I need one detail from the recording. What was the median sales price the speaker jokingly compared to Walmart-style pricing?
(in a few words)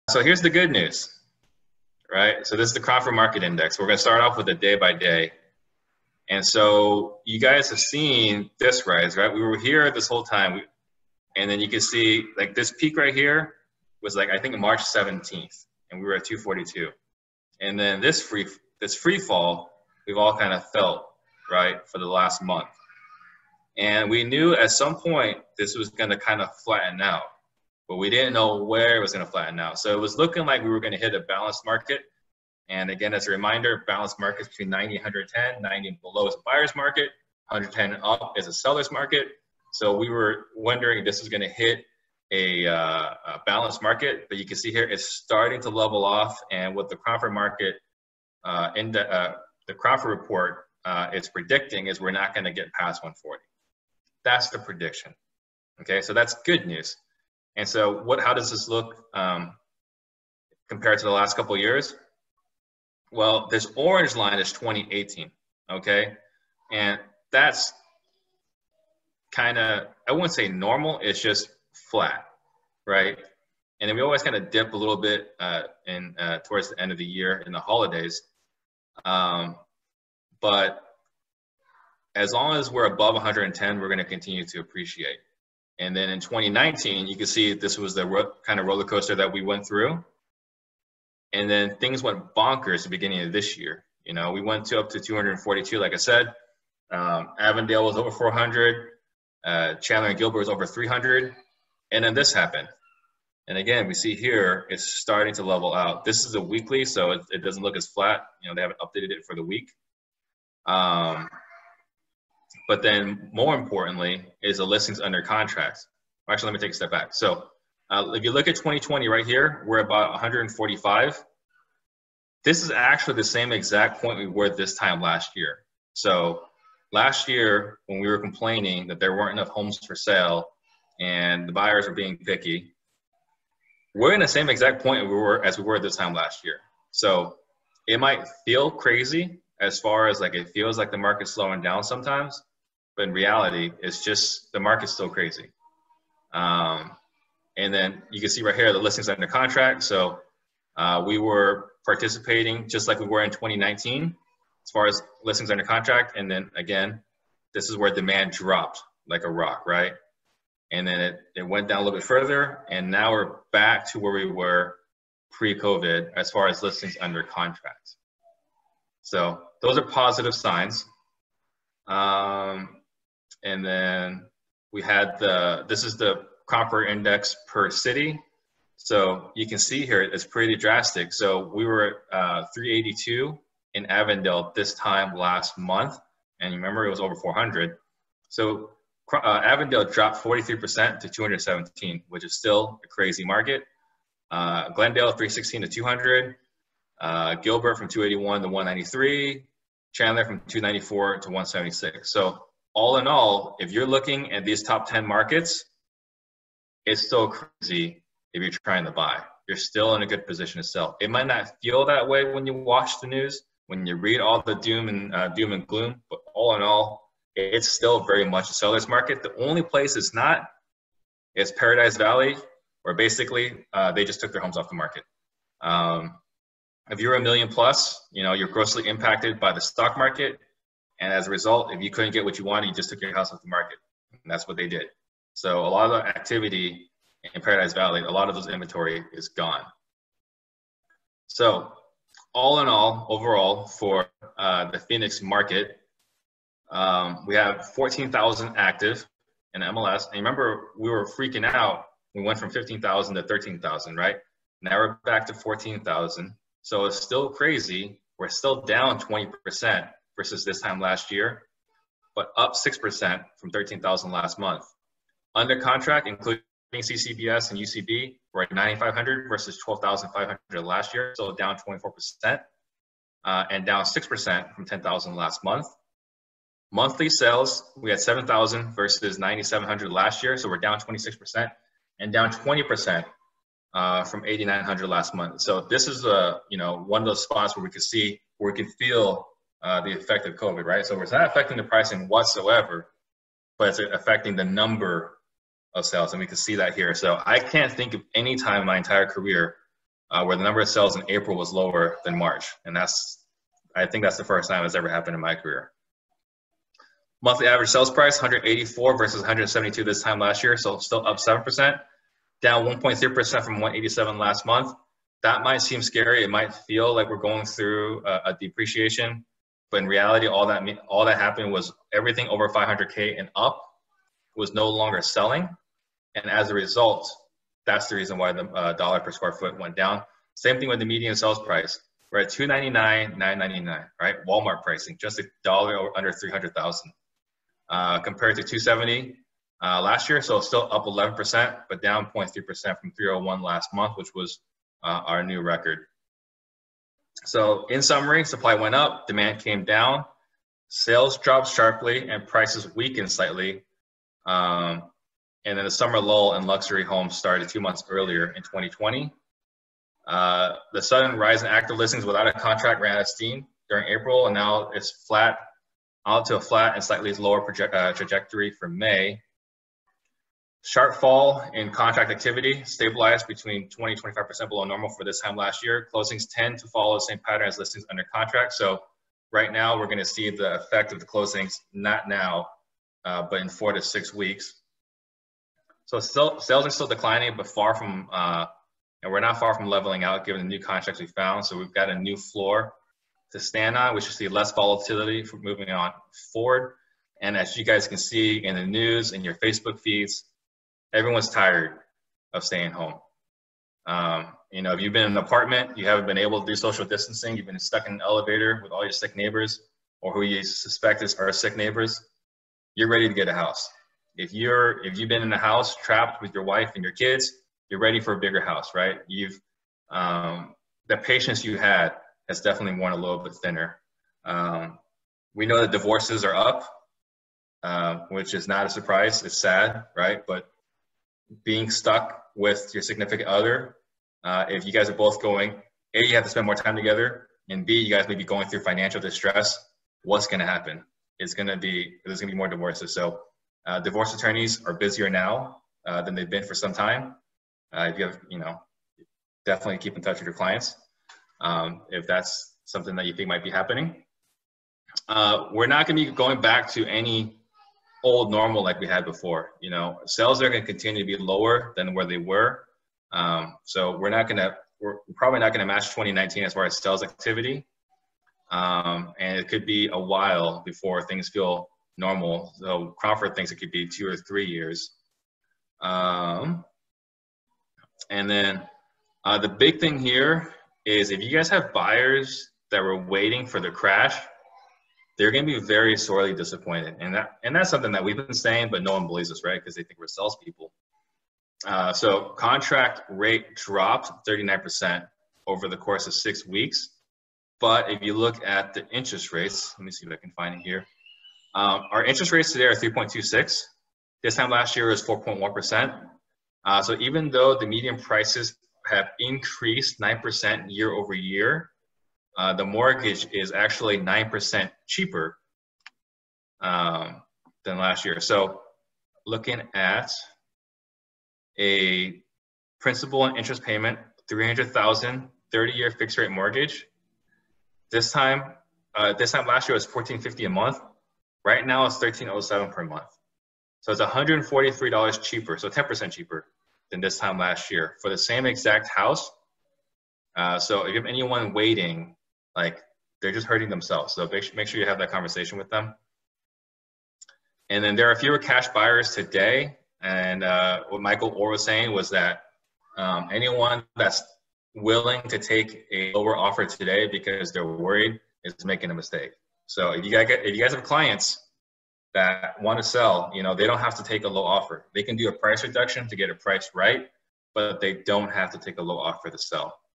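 $299,999.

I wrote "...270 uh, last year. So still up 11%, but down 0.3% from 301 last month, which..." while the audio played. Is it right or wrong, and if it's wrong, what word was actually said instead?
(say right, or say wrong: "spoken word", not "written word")
right.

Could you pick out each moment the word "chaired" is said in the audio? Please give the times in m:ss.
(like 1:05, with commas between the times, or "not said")
not said.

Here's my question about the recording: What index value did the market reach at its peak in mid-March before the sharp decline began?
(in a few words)
242.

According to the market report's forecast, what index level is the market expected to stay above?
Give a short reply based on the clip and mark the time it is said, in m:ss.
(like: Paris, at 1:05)
140, at 0:51.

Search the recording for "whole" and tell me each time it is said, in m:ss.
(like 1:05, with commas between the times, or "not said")
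0:10.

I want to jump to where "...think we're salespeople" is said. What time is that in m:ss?
8:09.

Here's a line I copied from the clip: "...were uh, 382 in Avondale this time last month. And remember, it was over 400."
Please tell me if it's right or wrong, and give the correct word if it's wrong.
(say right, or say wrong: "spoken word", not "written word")
right.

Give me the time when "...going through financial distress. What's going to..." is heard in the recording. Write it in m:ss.
7:18.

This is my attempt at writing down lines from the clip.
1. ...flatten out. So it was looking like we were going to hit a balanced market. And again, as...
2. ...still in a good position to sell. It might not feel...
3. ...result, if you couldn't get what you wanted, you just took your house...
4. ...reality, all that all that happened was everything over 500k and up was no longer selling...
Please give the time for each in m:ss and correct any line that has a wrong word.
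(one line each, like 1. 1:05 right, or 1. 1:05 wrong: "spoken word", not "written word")
1. 0:29 right
2. 3:29 right
3. 3:51 right
4. 5:19 right.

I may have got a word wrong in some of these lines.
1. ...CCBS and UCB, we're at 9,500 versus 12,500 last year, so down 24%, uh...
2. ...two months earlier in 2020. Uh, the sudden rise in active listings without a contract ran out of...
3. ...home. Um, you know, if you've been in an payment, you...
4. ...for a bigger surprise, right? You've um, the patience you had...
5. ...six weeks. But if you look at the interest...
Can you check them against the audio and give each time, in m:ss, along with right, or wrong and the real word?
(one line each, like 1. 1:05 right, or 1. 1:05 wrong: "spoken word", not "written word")
1. 4:26 right
2. 5:57 right
3. 6:42 wrong: "apartment", not "payment"
4. 6:58 wrong: "house", not "surprise"
5. 8:16 right.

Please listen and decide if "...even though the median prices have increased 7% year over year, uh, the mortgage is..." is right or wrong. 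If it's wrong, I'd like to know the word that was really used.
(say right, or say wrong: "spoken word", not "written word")
wrong: "9", not "7".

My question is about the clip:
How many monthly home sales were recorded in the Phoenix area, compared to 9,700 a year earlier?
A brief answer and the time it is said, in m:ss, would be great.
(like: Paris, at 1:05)
7,000, at 4:37.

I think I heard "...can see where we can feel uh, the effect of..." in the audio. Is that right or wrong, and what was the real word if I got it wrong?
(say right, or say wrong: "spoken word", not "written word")
right.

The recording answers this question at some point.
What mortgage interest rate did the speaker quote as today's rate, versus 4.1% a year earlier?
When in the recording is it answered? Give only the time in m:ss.
8:22.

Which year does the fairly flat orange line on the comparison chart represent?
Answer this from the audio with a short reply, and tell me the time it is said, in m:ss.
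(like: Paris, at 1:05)
2018, at 1:03.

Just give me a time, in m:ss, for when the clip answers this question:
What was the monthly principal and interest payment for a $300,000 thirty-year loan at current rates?
8:51.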